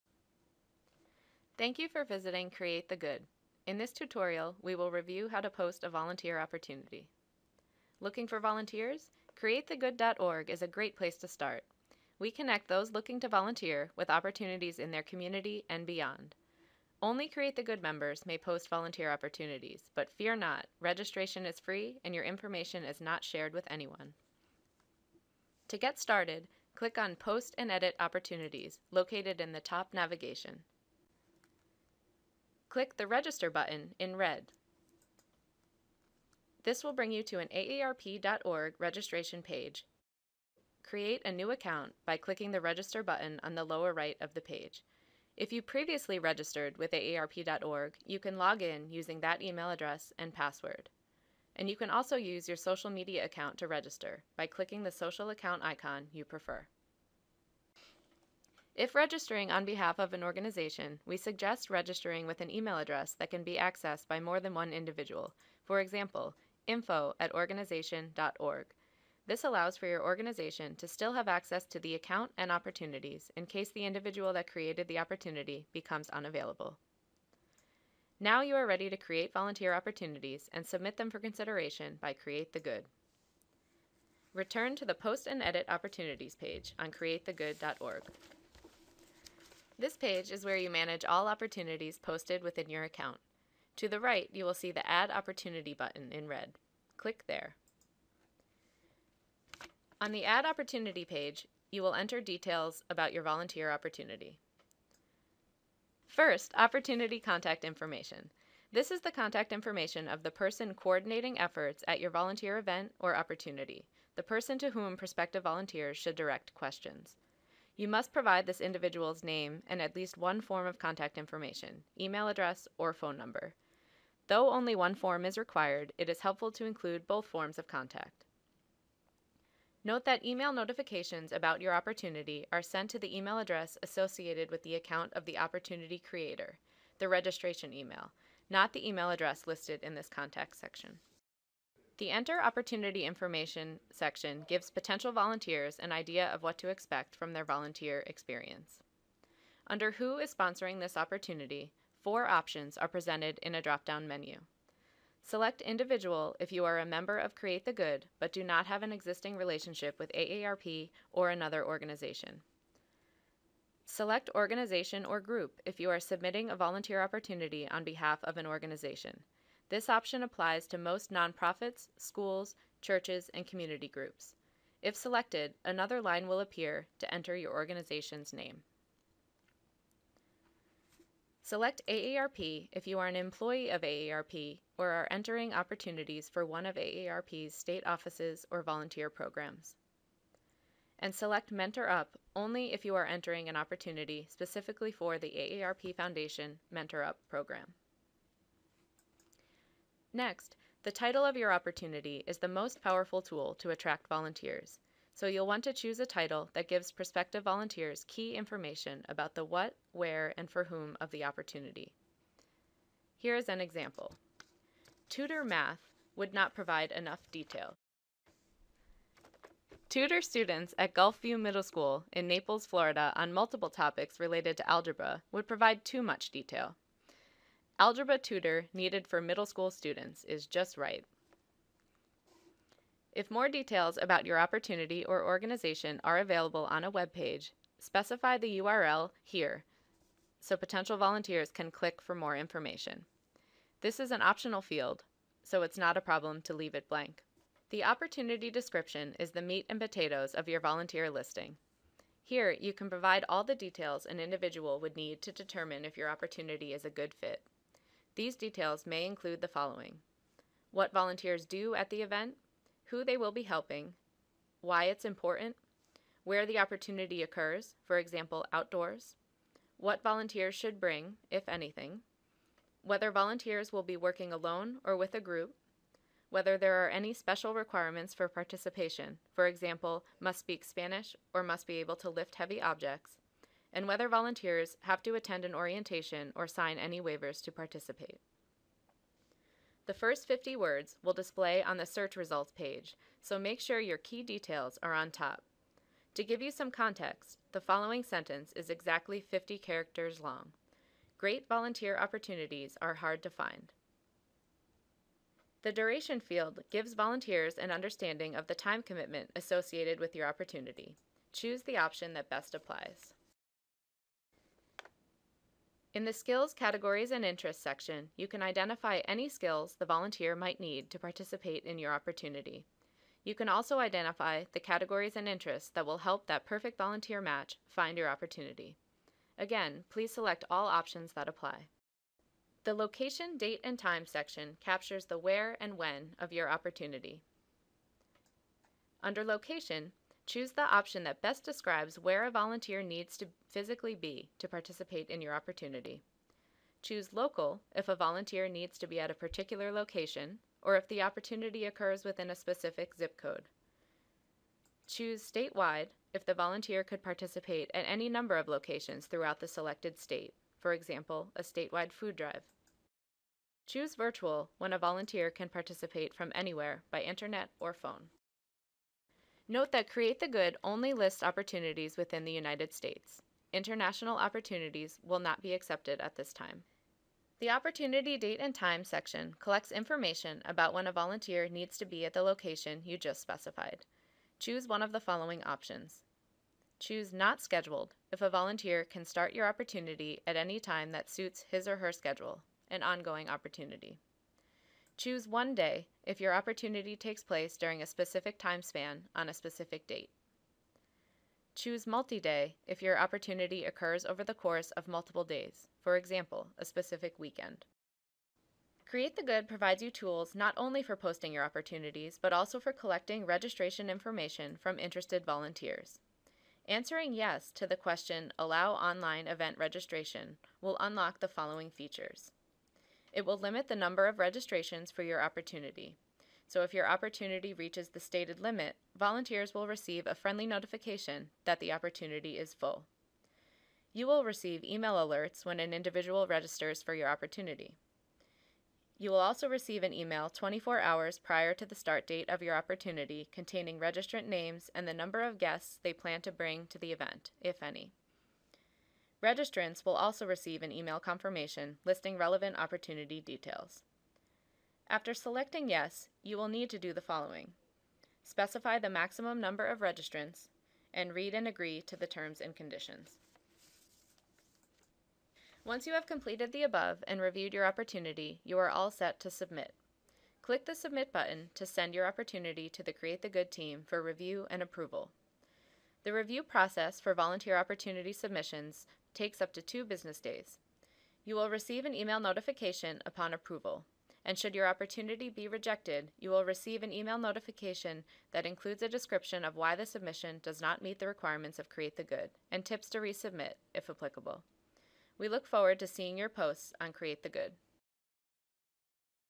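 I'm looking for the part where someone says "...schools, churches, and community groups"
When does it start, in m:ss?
2:51.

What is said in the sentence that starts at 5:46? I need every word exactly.
Choose local if a volunteer needs to be at a particular location or if the opportunity occurs within a specific zip code.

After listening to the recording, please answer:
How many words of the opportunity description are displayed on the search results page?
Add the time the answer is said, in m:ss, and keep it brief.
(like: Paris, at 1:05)
50, at 4:50.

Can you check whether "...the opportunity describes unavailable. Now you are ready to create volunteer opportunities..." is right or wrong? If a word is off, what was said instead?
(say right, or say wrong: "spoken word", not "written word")
wrong: "becomes", not "describes".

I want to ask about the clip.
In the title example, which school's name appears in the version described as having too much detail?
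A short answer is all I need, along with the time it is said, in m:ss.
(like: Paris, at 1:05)
Gulfview Middle School, at 3:40.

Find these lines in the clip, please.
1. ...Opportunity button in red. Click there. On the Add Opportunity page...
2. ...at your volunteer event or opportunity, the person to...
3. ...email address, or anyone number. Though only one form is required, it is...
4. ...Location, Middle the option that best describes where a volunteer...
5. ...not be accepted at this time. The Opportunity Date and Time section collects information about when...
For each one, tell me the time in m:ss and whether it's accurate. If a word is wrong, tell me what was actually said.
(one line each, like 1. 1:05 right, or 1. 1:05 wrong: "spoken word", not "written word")
1. 1:35 right
2. 1:51 right
3. 2:01 wrong: "phone", not "anyone"
4. 5:39 wrong: "Choose", not "Middle"
5. 6:15 right.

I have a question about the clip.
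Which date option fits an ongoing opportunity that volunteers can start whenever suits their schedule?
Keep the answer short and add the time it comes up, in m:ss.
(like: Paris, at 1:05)
Not Scheduled, at 6:27.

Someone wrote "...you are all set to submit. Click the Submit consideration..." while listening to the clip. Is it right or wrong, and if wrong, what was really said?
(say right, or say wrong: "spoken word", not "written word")
wrong: "button", not "consideration".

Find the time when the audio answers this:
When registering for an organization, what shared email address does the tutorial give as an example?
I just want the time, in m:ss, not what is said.
1:06.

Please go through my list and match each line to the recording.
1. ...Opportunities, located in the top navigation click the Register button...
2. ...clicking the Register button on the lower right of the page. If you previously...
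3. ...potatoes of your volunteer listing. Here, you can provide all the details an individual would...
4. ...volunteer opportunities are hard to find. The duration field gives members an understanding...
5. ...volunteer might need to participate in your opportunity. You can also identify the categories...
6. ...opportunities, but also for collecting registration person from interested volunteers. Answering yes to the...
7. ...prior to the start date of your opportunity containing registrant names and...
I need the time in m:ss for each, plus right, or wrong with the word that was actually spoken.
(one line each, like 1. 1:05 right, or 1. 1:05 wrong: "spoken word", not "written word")
1. 0:27 right
2. 0:42 right
3. 4:09 right
4. 5:01 wrong: "volunteers", not "members"
5. 5:19 right
6. 6:51 wrong: "information", not "person"
7. 7:21 right.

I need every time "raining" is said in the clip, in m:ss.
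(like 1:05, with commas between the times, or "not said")
not said.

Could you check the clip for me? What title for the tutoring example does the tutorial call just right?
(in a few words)
Algebra tutor needed for middle school students.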